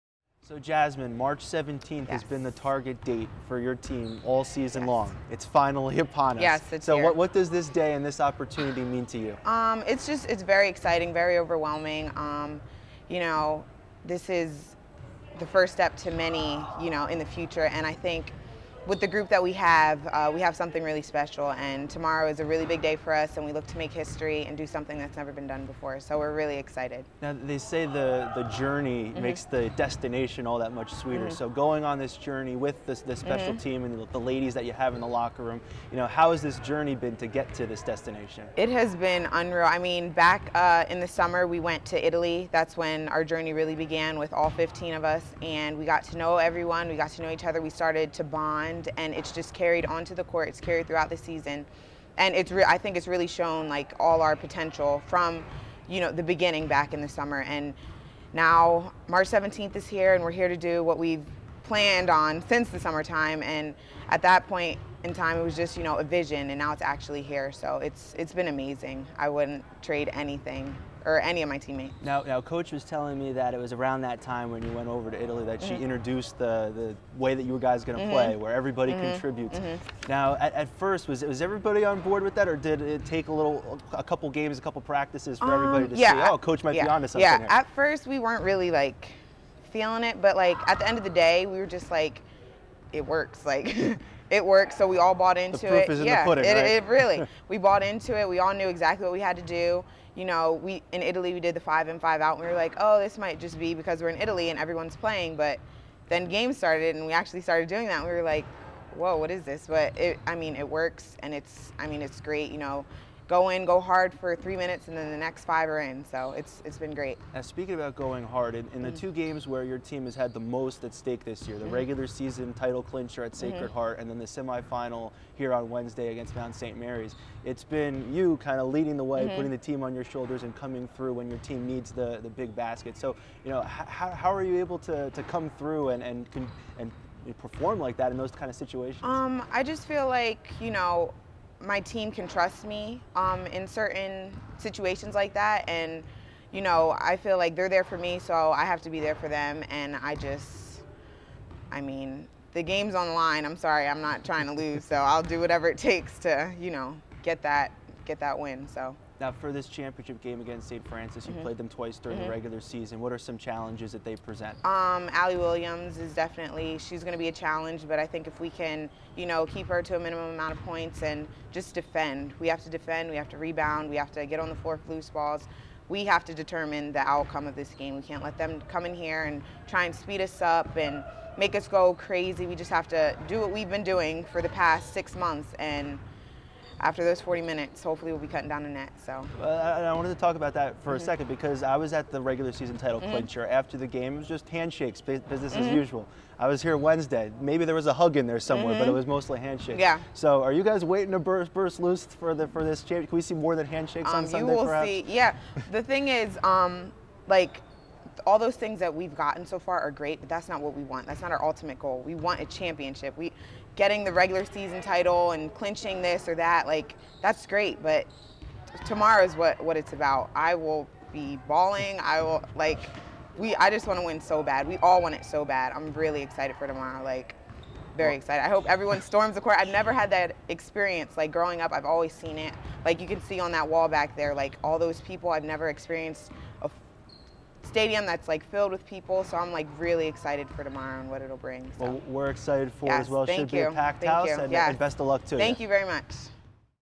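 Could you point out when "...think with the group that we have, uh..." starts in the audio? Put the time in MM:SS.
00:17.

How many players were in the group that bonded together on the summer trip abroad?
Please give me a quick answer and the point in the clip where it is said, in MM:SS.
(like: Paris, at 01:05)
15, at 00:44.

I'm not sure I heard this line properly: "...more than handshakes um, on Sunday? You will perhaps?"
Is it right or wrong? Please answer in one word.
right.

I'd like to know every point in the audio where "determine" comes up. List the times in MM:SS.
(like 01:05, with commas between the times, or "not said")
02:56.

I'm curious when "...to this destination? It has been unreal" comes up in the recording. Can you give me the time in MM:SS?
00:37.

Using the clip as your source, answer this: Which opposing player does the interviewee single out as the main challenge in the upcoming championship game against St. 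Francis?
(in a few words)
Allie Williams.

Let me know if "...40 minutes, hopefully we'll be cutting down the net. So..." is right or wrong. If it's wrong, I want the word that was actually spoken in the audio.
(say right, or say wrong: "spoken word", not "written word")
right.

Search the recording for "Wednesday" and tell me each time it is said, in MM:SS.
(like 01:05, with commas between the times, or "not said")
02:05, 03:16.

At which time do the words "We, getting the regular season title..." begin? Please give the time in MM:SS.
03:33.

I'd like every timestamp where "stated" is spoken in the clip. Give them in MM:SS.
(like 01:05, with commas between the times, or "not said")
not said.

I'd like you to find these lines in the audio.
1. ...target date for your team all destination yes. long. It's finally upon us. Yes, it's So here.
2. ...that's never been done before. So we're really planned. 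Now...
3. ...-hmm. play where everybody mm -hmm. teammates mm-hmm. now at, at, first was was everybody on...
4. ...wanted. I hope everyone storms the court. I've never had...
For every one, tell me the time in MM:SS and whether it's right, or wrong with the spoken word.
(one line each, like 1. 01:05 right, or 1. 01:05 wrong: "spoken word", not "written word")
1. 00:02 wrong: "season", not "destination"
2. 00:24 wrong: "excited", not "planned"
3. 01:18 wrong: "contributes", not "teammates"
4. 03:48 wrong: "excited", not "wanted".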